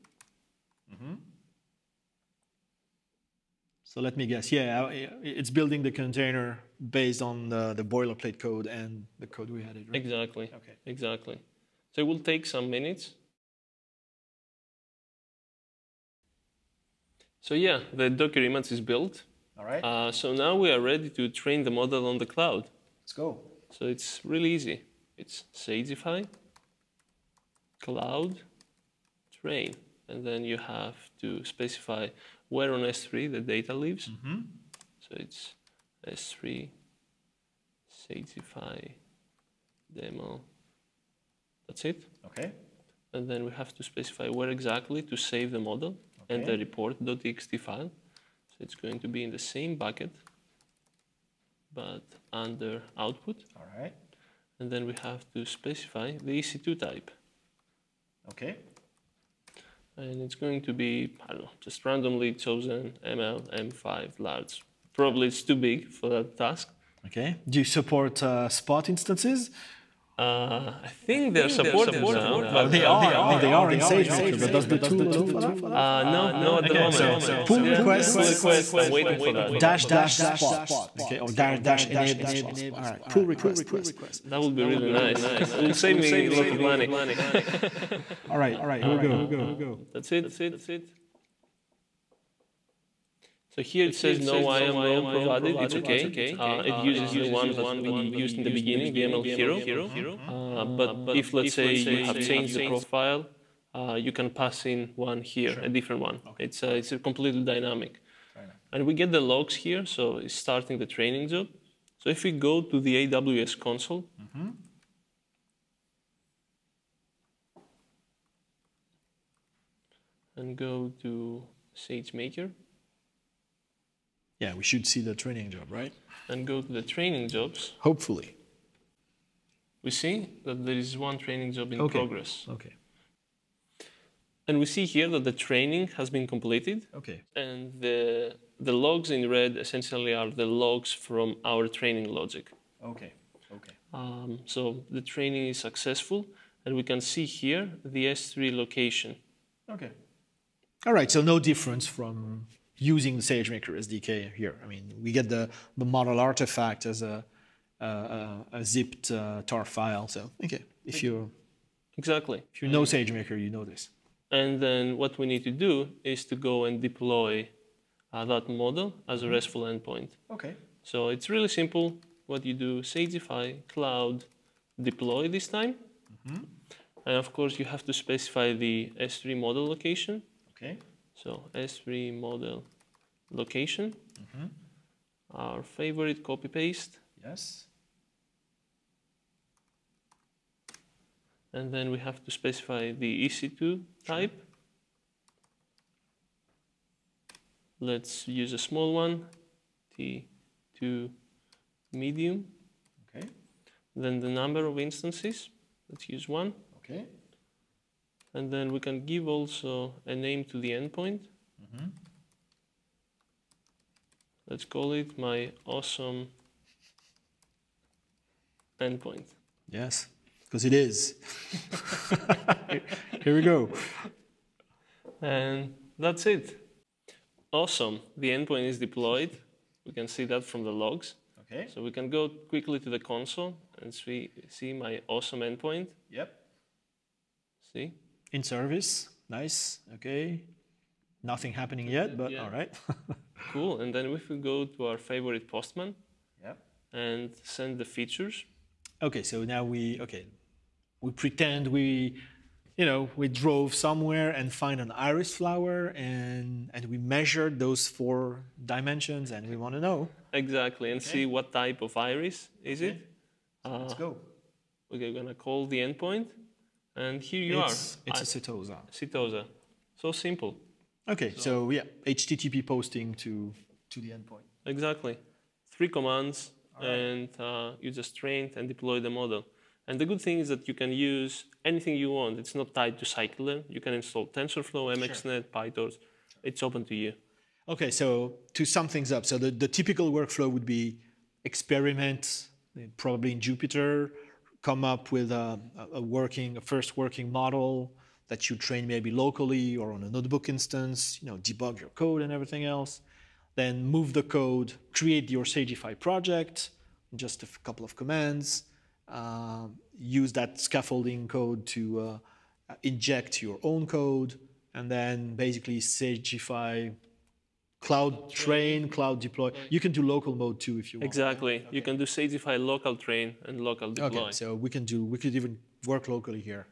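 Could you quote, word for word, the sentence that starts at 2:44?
And then what we need to do is to go and deploy uh, that model as a mm-hmm.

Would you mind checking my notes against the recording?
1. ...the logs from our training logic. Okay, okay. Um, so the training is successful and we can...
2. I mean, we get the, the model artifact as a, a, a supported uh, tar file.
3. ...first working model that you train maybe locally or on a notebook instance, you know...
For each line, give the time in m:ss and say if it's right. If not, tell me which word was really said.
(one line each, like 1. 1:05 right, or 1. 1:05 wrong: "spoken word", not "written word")
1. 2:20 right
2. 2:34 wrong: "zipped", not "supported"
3. 4:56 right.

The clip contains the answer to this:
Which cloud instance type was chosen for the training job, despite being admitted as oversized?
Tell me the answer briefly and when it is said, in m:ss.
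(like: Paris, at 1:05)
ML M5 large, at 1:03.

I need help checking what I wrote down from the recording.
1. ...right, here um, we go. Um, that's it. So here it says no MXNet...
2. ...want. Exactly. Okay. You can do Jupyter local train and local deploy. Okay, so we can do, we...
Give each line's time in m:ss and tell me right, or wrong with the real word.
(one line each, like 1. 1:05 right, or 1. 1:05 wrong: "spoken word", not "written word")
1. 1:28 wrong: "IAM", not "MXNet"
2. 5:20 wrong: "Sagify", not "Jupyter".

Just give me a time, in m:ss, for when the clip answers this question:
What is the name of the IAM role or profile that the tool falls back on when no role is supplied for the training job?
1:39.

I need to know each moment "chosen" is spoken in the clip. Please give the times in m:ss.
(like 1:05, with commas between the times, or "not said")
1:02.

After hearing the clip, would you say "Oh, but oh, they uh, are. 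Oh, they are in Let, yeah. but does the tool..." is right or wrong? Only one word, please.
wrong.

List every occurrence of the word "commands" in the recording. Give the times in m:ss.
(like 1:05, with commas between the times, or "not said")
4:35, 5:07.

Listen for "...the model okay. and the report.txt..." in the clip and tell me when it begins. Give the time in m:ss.
0:45.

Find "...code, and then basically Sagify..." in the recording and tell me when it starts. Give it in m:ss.
5:13.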